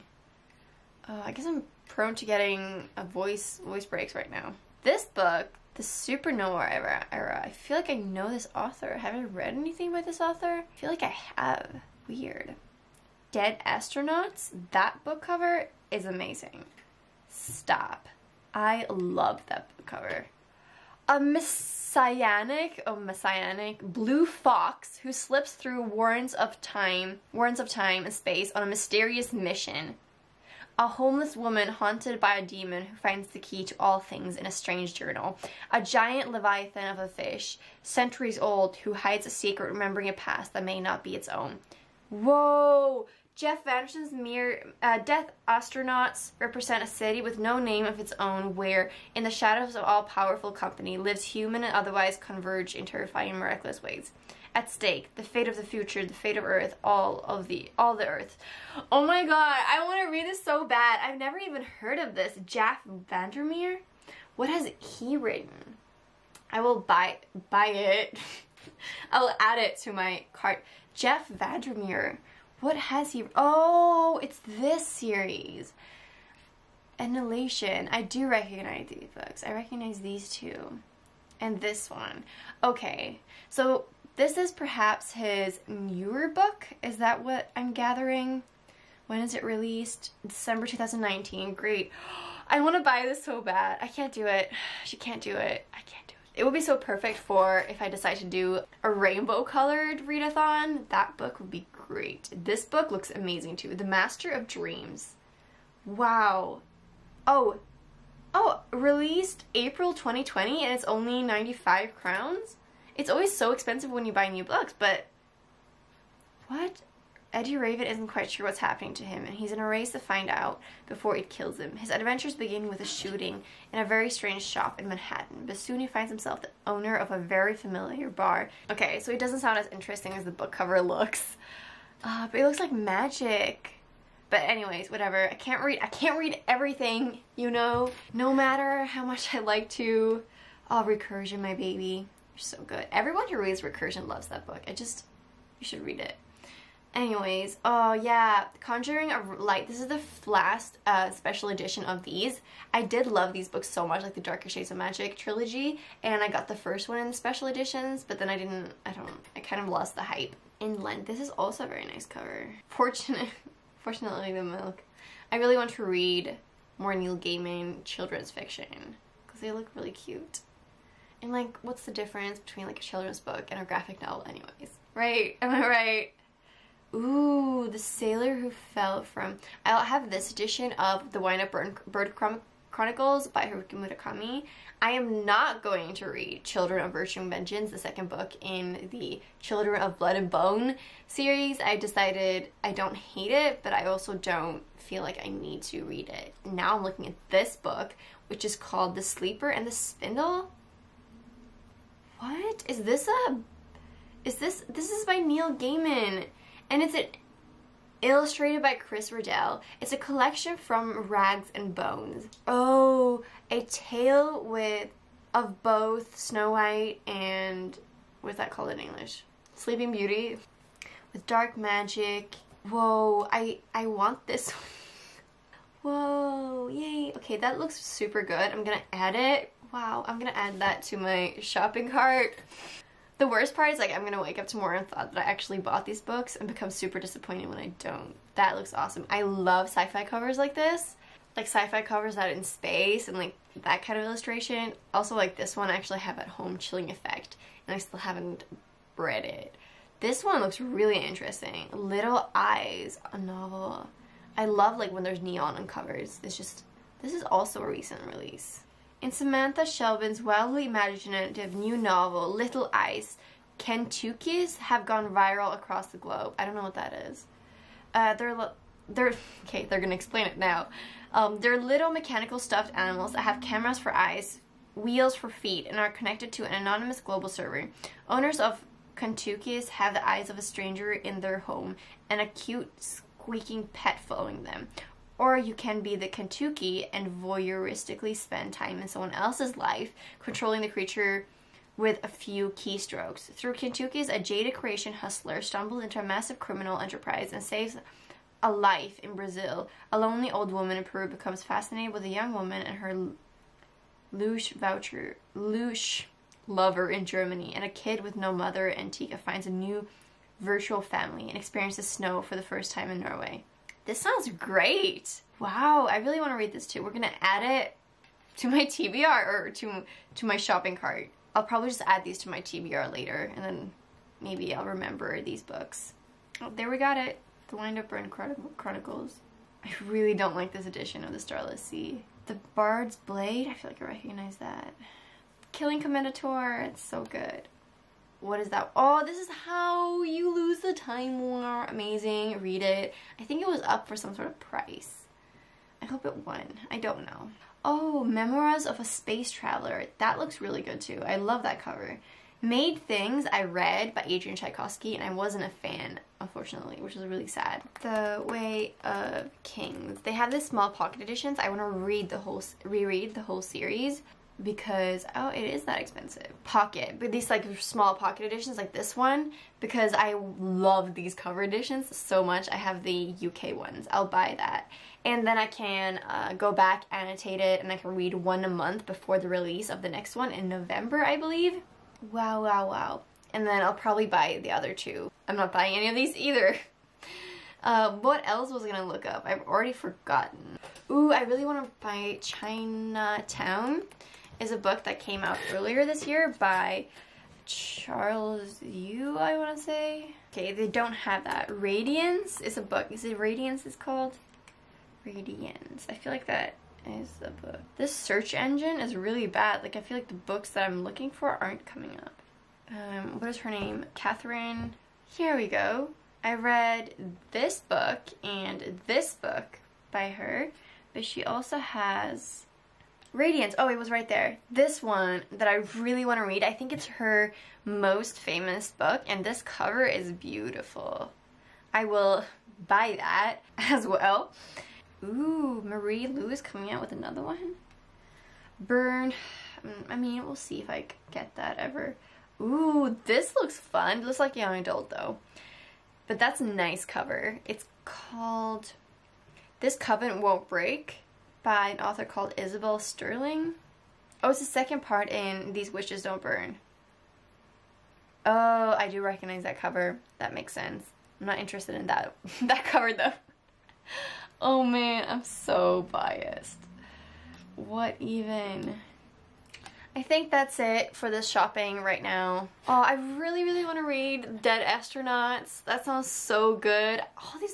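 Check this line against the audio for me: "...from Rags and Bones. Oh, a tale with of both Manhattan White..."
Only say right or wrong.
wrong.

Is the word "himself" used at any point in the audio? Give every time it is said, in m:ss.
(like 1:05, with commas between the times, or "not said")
2:06.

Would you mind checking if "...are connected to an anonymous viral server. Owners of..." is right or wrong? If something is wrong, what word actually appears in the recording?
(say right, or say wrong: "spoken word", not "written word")
wrong: "global", not "viral".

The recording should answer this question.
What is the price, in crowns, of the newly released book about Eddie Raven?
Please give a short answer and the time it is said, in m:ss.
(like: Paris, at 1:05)
95, at 1:51.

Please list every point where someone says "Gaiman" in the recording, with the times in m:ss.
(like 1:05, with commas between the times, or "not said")
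2:47, 3:25.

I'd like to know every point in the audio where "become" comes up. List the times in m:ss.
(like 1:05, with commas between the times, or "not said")
3:56, 5:01.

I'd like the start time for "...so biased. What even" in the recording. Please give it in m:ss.
7:45.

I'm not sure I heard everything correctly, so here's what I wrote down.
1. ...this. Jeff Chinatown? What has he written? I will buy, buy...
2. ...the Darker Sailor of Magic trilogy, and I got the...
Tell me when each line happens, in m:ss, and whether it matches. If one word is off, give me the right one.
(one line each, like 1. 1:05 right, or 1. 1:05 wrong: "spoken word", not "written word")
1. 1:02 wrong: "Vandermeer", not "Chinatown"
2. 2:34 wrong: "Shades", not "Sailor".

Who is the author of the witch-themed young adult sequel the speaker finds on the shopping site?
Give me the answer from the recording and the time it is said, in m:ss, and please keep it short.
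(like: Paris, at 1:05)
Isabel Sterling, at 7:32.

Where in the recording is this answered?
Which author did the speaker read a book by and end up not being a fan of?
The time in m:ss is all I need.
5:54.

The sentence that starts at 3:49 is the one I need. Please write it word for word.
Wow, I'm gonna add that to my shopping cart.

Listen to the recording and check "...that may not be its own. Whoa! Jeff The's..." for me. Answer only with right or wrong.
wrong.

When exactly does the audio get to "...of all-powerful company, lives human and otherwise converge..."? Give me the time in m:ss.
0:49.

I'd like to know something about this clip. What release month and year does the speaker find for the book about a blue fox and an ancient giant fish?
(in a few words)
December 2019.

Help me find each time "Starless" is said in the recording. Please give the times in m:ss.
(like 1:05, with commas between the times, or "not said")
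5:31.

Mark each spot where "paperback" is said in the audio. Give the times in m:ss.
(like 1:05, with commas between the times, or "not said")
not said.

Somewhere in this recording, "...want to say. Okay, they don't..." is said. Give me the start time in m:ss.
6:39.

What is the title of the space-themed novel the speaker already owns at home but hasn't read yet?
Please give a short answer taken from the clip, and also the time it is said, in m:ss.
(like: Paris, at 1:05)
Chilling Effect, at 4:06.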